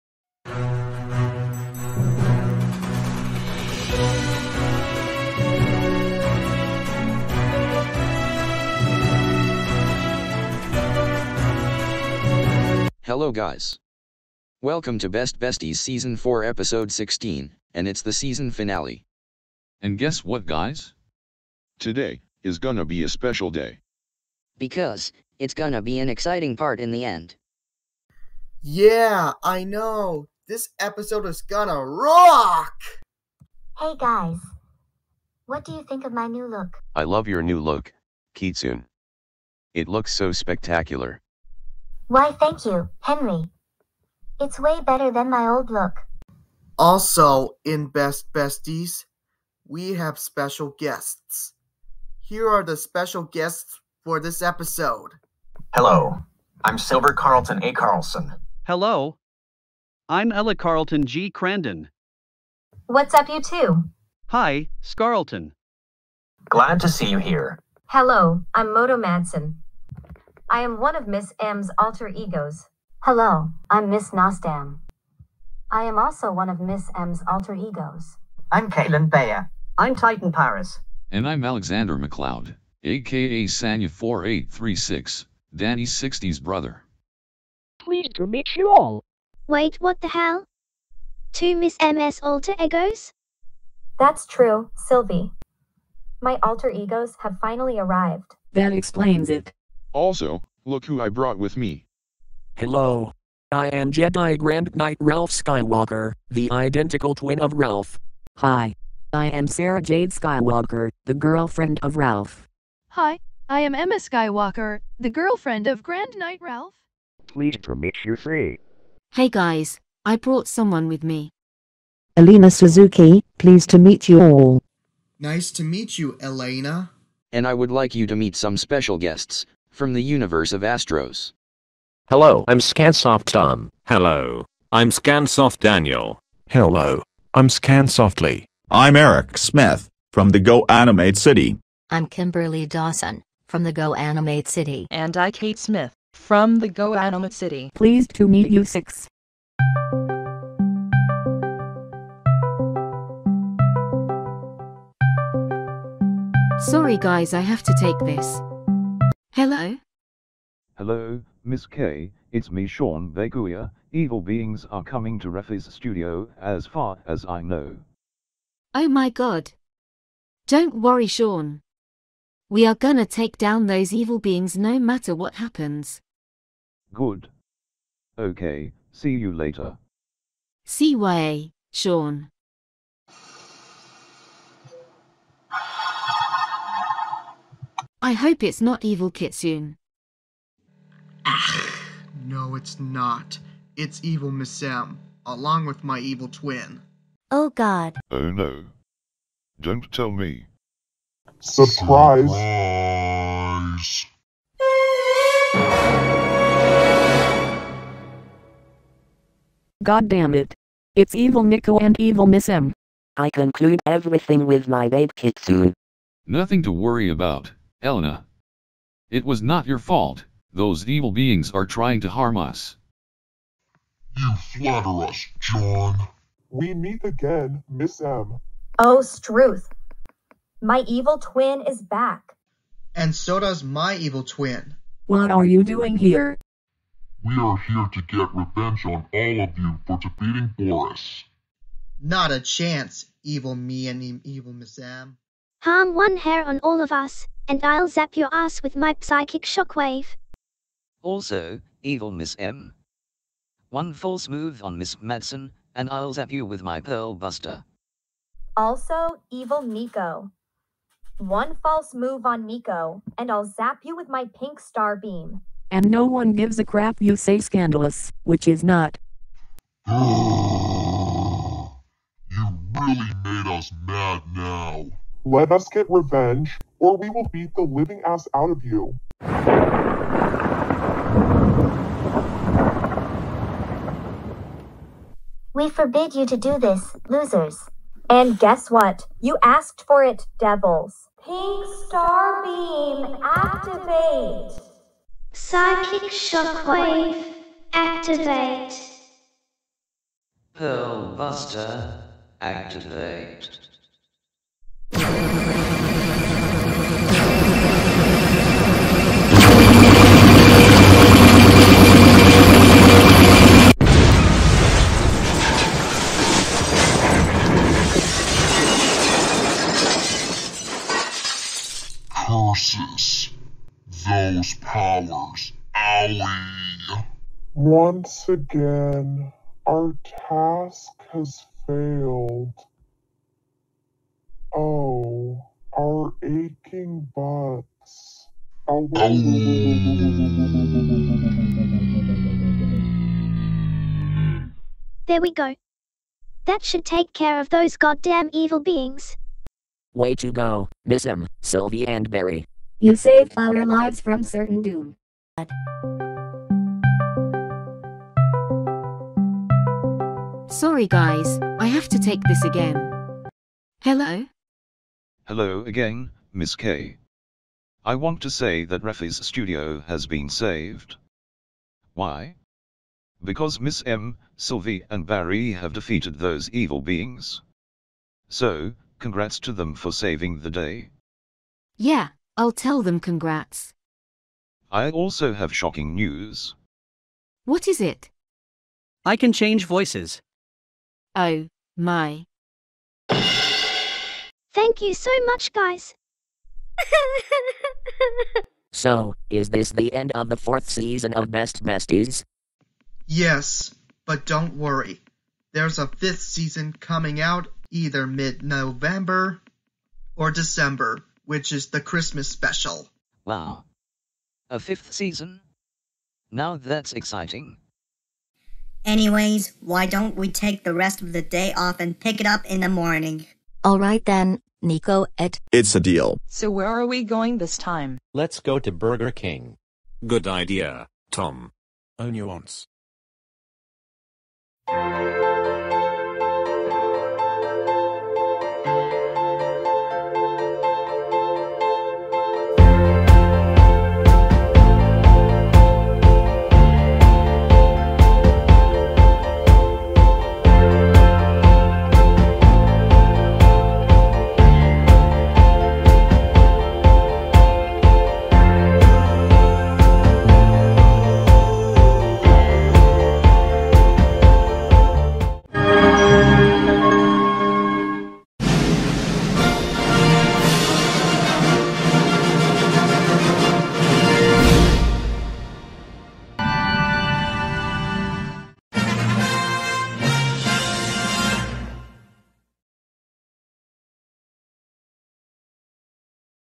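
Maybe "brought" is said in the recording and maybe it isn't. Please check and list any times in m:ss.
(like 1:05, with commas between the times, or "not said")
1:41, 2:00.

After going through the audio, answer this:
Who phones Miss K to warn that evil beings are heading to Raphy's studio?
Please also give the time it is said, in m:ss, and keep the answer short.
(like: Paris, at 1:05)
Sean Veguia, at 2:42.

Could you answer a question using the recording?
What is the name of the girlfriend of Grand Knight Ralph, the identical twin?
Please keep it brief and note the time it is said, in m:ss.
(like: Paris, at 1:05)
Emma Skywalker, at 1:53.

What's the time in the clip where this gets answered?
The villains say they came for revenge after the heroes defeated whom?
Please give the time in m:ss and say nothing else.
4:00.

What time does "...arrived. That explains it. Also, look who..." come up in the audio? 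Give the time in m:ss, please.
1:37.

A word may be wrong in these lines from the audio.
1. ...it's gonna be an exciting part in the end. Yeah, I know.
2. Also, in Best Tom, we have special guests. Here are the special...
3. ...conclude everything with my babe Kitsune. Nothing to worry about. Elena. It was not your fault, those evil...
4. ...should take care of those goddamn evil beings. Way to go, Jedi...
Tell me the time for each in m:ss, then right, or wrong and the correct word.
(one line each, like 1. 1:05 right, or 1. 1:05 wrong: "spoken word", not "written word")
1. 0:25 right
2. 0:46 wrong: "Besties", not "Tom"
3. 3:33 right
4. 5:46 wrong: "Miss", not "Jedi".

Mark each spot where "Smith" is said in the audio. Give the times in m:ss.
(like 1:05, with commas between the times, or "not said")
2:19, 2:25.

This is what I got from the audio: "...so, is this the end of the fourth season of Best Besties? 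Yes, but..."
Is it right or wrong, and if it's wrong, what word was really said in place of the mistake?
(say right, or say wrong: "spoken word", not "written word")
right.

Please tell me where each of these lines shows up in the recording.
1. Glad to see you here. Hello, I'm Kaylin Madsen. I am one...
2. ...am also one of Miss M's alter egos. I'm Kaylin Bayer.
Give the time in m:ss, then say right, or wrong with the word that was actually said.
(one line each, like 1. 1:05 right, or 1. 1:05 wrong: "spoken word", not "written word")
1. 1:06 wrong: "Moto", not "Kaylin"
2. 1:15 right.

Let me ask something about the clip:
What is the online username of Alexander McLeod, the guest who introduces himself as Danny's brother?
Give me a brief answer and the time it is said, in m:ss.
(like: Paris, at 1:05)
Sanya4836, at 1:23.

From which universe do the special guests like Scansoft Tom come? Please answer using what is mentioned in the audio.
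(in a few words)
Astros.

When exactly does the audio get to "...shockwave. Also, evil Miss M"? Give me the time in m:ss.
4:09.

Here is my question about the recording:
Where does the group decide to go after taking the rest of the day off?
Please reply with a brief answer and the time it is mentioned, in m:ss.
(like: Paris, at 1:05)
Burger King, at 7:08.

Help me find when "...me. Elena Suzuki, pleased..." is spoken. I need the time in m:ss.
2:01.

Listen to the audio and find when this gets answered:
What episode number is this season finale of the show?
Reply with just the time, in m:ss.
0:16.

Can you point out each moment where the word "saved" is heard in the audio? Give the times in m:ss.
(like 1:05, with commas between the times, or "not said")
5:52, 6:10.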